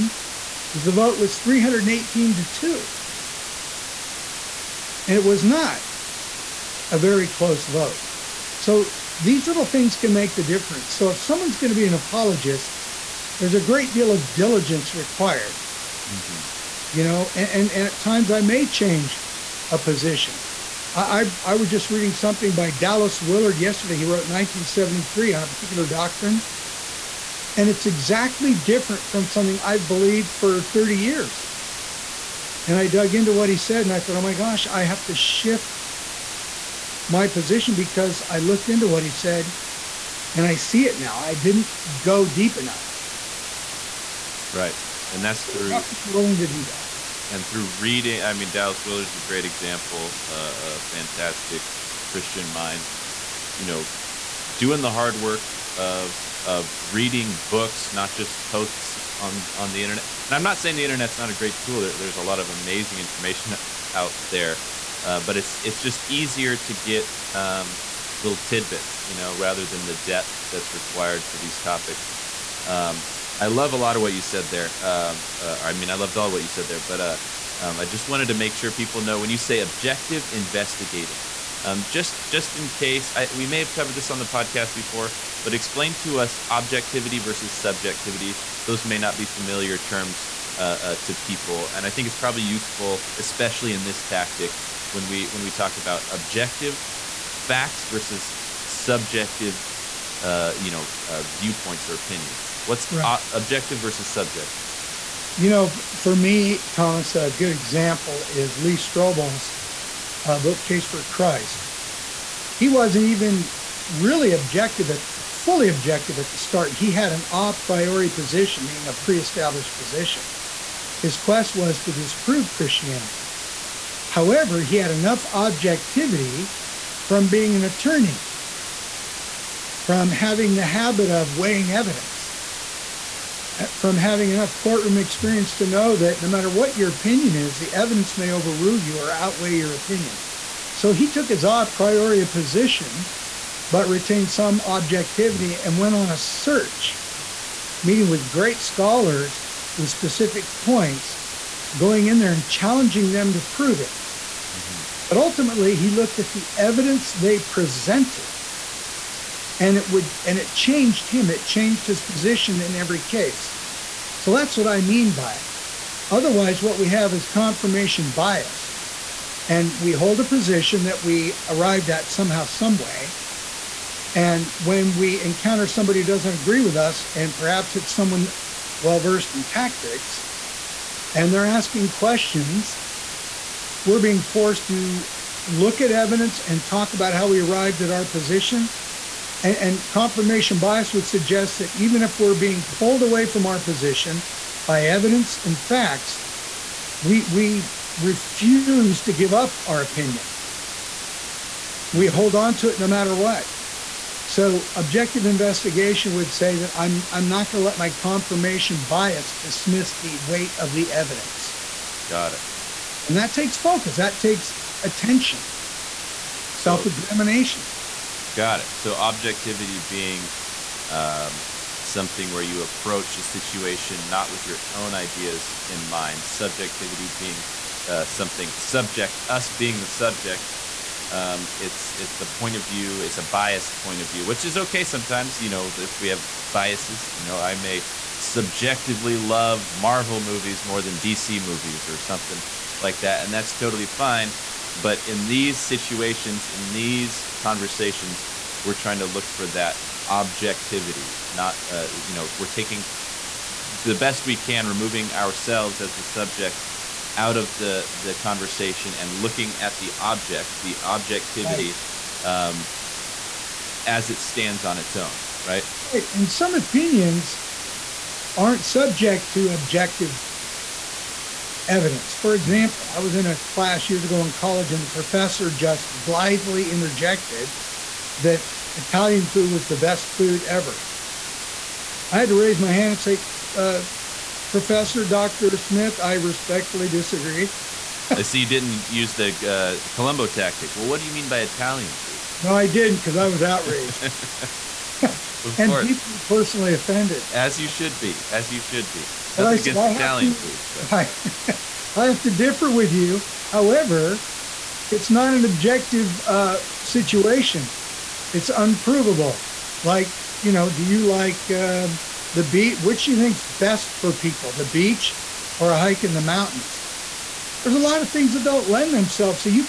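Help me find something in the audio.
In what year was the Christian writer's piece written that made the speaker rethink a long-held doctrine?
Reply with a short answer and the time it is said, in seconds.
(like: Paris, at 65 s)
1973, at 24 s.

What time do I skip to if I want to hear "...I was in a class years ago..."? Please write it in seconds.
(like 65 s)
272 s.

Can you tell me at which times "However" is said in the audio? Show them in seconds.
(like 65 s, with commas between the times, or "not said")
124 s, 303 s.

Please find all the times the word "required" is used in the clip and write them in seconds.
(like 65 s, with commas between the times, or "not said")
14 s, 70 s.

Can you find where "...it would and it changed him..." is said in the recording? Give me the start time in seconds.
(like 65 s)
159 s.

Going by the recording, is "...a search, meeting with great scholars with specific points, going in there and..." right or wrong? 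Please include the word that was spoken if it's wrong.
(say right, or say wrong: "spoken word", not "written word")
right.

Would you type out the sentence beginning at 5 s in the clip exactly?
And it was not a very close vote.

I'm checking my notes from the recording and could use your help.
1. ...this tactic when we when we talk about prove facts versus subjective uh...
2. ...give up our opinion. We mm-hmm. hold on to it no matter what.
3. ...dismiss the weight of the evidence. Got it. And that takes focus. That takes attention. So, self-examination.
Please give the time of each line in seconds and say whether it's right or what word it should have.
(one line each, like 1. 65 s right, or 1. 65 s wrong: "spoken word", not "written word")
1. 93 s wrong: "objective", not "prove"
2. 199 s right
3. 209 s right.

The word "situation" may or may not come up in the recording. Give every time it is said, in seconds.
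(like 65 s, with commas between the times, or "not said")
223 s, 245 s, 306 s.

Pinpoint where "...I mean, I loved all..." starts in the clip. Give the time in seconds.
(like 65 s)
75 s.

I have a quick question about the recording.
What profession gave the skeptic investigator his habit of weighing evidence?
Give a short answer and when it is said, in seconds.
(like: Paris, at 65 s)
Attorney, at 127 s.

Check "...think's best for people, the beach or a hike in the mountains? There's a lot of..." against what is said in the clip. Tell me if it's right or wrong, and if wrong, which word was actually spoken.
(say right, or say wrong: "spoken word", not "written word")
right.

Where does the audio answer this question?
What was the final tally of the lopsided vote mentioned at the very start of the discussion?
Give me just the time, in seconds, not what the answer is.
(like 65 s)
1 s.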